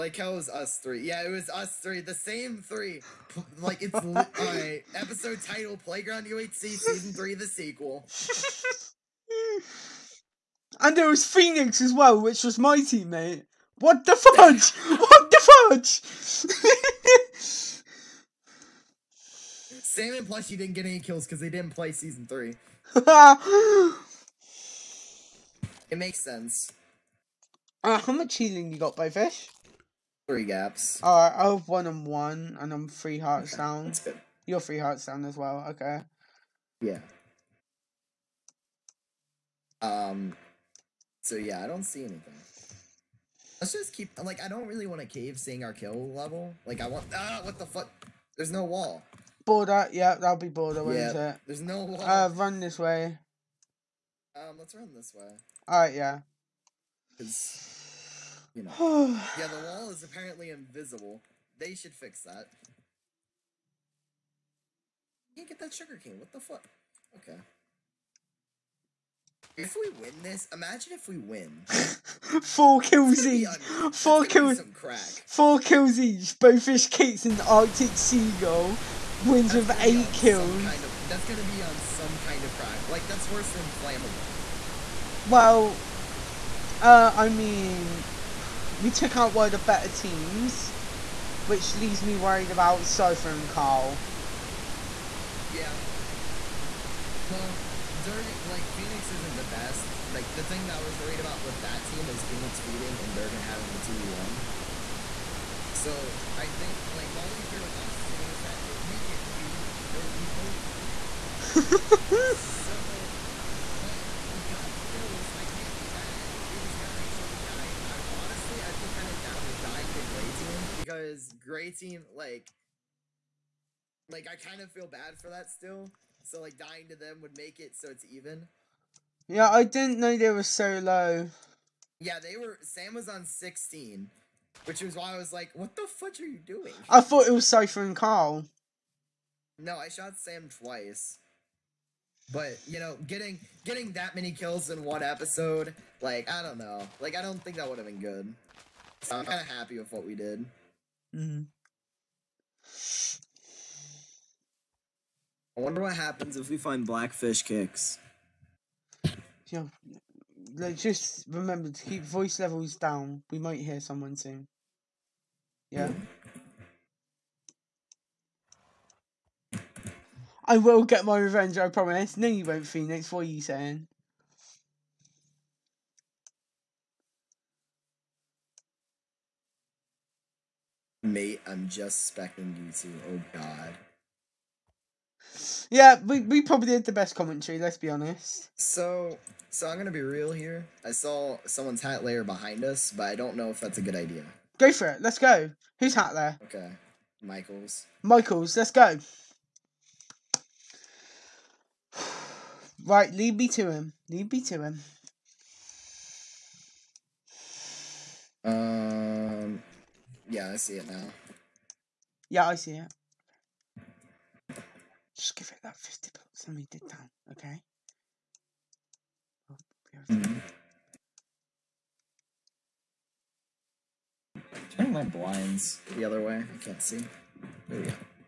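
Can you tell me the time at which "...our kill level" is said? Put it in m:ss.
0:45.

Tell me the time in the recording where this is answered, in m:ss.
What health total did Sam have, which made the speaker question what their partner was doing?
2:13.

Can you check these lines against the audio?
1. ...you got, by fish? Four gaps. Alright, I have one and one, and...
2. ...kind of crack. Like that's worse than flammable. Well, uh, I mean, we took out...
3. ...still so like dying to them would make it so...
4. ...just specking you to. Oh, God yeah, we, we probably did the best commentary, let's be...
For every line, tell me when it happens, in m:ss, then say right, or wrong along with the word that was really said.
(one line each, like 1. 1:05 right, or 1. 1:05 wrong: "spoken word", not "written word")
1. 0:28 wrong: "Three", not "Four"
2. 1:22 right
3. 2:05 right
4. 3:01 right.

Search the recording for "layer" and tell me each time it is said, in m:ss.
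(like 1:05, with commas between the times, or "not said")
3:12, 3:16.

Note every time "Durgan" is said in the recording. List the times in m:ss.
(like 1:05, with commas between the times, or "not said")
1:37, 1:43.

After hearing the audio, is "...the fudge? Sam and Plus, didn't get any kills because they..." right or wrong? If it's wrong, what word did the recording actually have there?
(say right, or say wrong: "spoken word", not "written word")
right.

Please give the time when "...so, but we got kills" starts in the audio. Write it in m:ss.
1:51.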